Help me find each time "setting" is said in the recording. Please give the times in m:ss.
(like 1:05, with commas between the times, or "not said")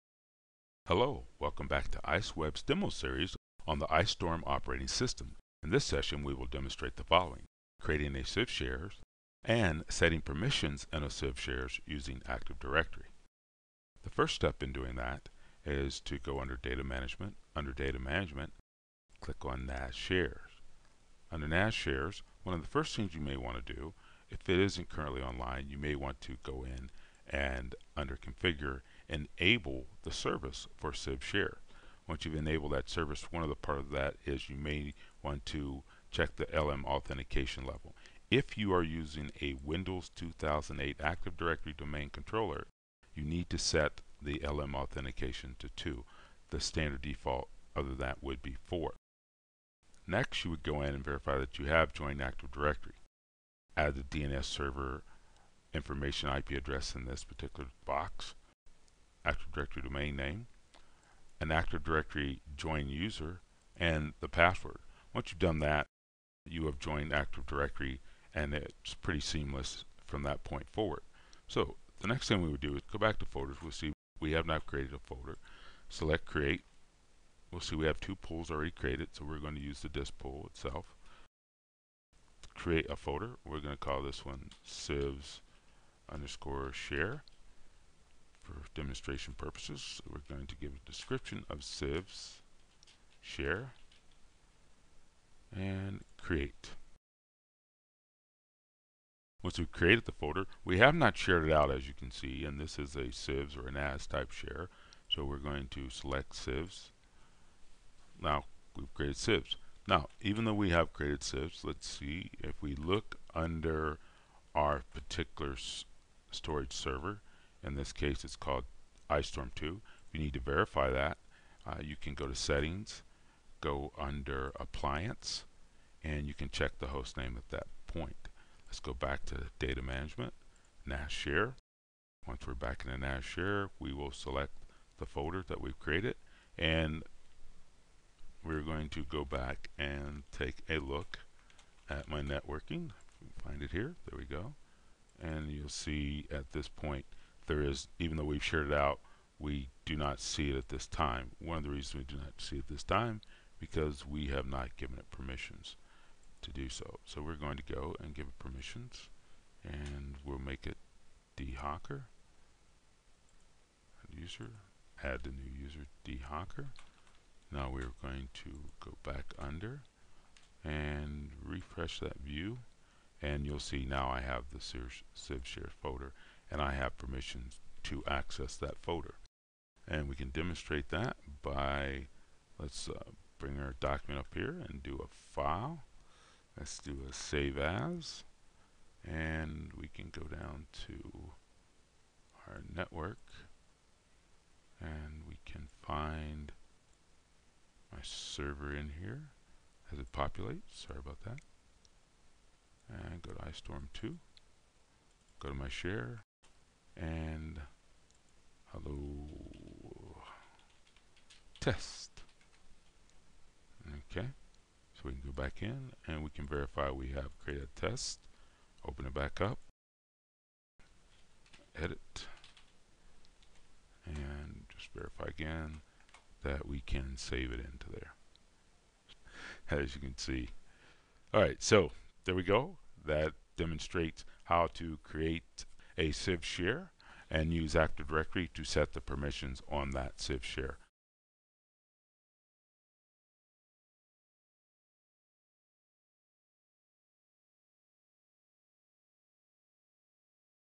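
0:09, 2:02.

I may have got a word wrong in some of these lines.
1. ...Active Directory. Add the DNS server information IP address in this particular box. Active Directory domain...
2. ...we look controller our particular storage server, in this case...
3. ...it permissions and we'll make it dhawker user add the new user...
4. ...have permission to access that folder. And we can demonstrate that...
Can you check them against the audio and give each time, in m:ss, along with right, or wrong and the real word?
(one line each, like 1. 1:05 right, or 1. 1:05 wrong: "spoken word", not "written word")
1. 0:52 right
2. 1:52 wrong: "under", not "controller"
3. 2:38 right
4. 2:56 right.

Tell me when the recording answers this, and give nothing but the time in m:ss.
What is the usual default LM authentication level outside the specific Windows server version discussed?
0:46.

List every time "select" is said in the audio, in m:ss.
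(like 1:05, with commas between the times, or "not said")
1:15, 1:45, 2:14.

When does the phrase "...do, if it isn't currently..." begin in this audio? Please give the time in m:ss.
0:23.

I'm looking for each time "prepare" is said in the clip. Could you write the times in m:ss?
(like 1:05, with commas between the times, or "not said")
not said.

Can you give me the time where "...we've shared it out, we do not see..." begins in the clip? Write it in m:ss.
2:28.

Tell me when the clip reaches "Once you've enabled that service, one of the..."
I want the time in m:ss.
0:32.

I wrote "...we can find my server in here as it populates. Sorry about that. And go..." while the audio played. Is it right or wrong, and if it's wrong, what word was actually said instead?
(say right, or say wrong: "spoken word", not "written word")
right.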